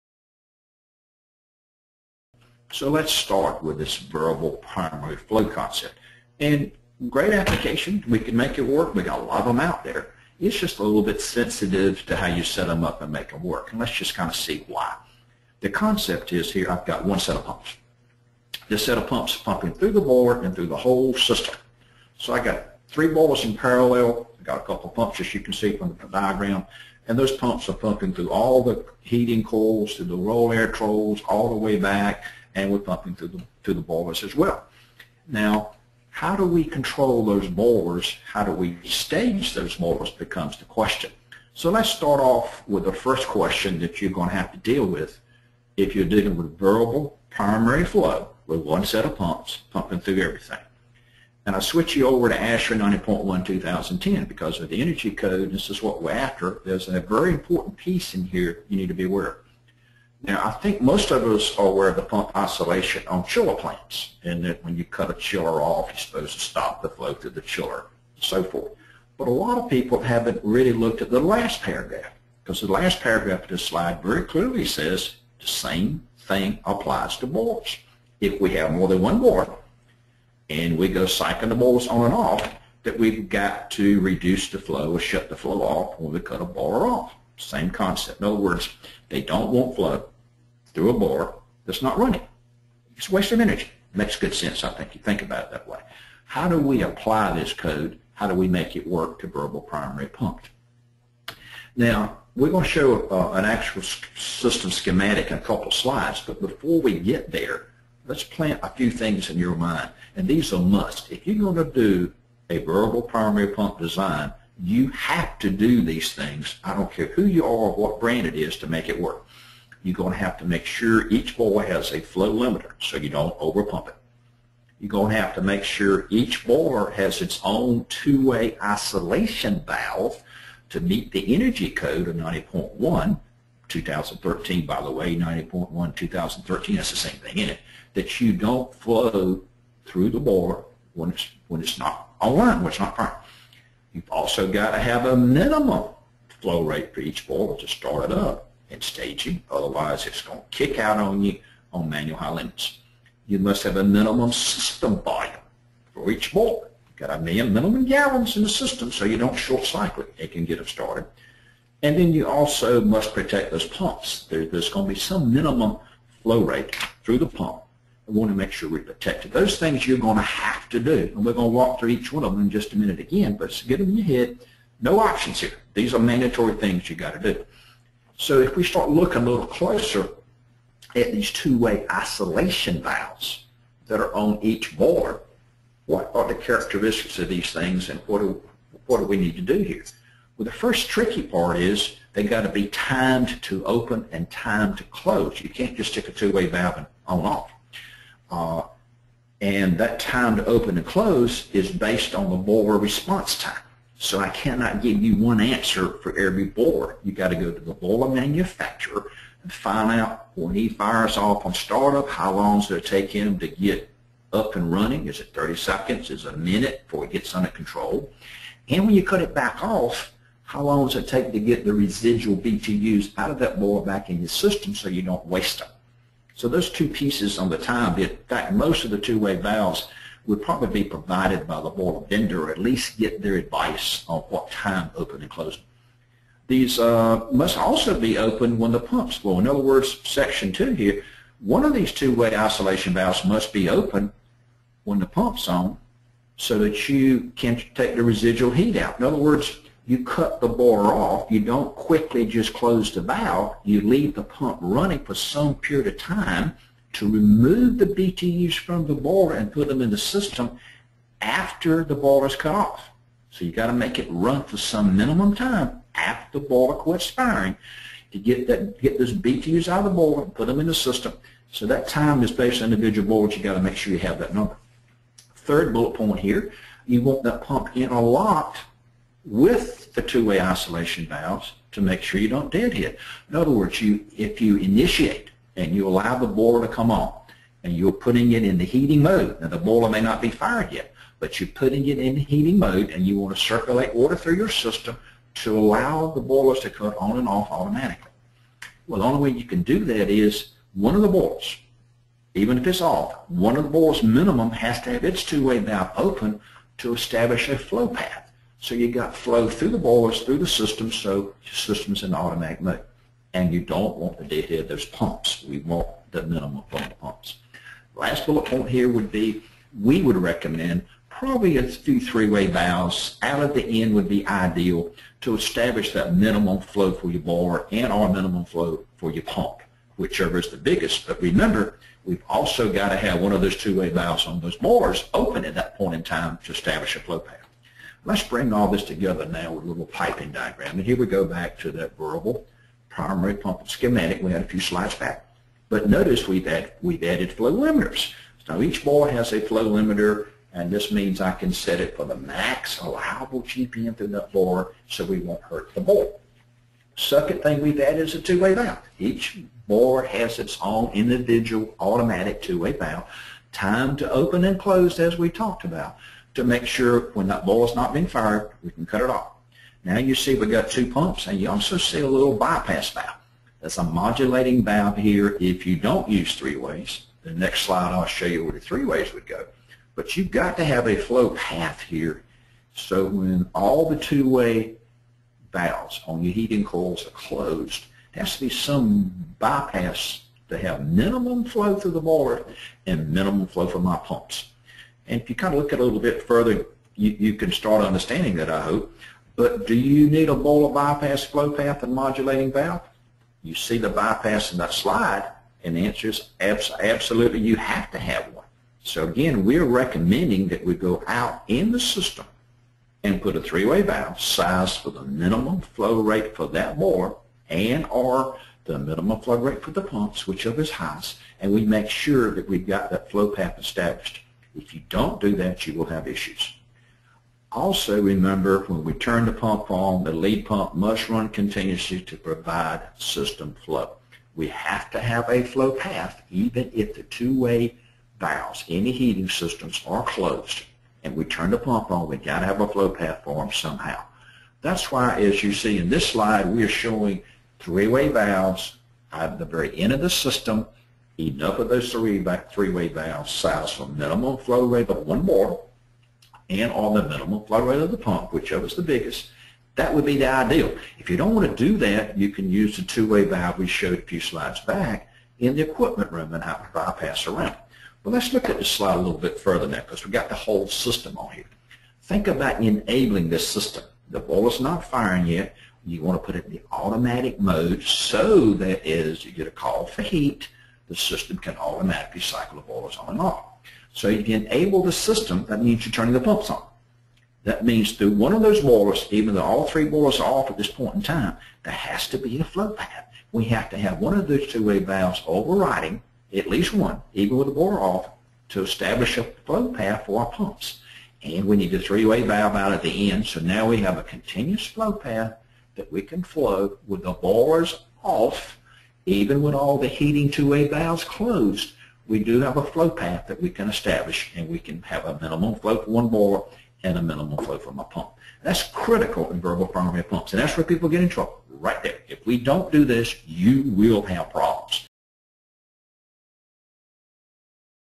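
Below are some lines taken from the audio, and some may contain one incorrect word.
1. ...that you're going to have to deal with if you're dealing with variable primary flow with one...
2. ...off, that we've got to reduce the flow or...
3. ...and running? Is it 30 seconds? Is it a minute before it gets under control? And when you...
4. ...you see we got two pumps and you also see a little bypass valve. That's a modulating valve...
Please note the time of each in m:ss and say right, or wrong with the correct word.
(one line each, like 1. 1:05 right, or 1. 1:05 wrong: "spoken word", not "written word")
1. 0:43 right
2. 1:22 right
3. 3:34 right
4. 6:09 right.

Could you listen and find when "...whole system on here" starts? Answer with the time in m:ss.
7:50.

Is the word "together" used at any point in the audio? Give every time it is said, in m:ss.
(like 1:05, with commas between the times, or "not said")
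5:38.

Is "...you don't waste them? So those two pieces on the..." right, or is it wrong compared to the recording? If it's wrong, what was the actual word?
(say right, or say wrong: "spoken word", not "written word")
right.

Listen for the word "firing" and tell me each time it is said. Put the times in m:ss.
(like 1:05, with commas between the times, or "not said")
4:27, 7:54.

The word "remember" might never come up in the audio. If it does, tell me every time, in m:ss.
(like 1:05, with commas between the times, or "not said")
5:31, 7:08.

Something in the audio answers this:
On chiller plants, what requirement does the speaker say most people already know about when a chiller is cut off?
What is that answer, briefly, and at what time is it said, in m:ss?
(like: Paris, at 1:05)
pump isolation, at 1:02.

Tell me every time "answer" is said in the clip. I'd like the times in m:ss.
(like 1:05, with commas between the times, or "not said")
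3:25, 6:45.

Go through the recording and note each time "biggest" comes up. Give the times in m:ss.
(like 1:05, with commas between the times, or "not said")
5:30, 7:38.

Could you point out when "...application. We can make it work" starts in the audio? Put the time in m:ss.
0:07.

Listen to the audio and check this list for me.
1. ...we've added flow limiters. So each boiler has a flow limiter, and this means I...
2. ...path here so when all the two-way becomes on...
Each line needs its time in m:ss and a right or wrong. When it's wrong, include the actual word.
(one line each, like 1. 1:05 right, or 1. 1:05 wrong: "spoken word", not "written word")
1. 5:46 right
2. 6:21 wrong: "valves", not "becomes".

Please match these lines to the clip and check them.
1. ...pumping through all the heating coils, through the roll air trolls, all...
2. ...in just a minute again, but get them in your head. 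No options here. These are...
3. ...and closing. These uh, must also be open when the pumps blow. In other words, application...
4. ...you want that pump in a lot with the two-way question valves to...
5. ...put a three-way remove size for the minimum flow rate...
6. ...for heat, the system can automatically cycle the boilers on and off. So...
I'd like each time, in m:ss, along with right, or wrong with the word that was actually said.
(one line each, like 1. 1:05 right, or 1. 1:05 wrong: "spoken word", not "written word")
1. 0:27 right
2. 2:52 right
3. 3:55 wrong: "section", not "application"
4. 4:36 wrong: "isolation", not "question"
5. 6:53 wrong: "valve", not "remove"
6. 7:59 right.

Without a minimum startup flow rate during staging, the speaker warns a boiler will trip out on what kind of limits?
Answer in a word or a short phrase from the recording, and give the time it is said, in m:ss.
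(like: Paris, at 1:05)
manual high limits, at 2:31.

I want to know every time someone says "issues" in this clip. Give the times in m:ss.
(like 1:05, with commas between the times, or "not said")
7:06.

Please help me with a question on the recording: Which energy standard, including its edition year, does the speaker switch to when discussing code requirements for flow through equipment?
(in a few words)
ASHRAE 90.1 2010.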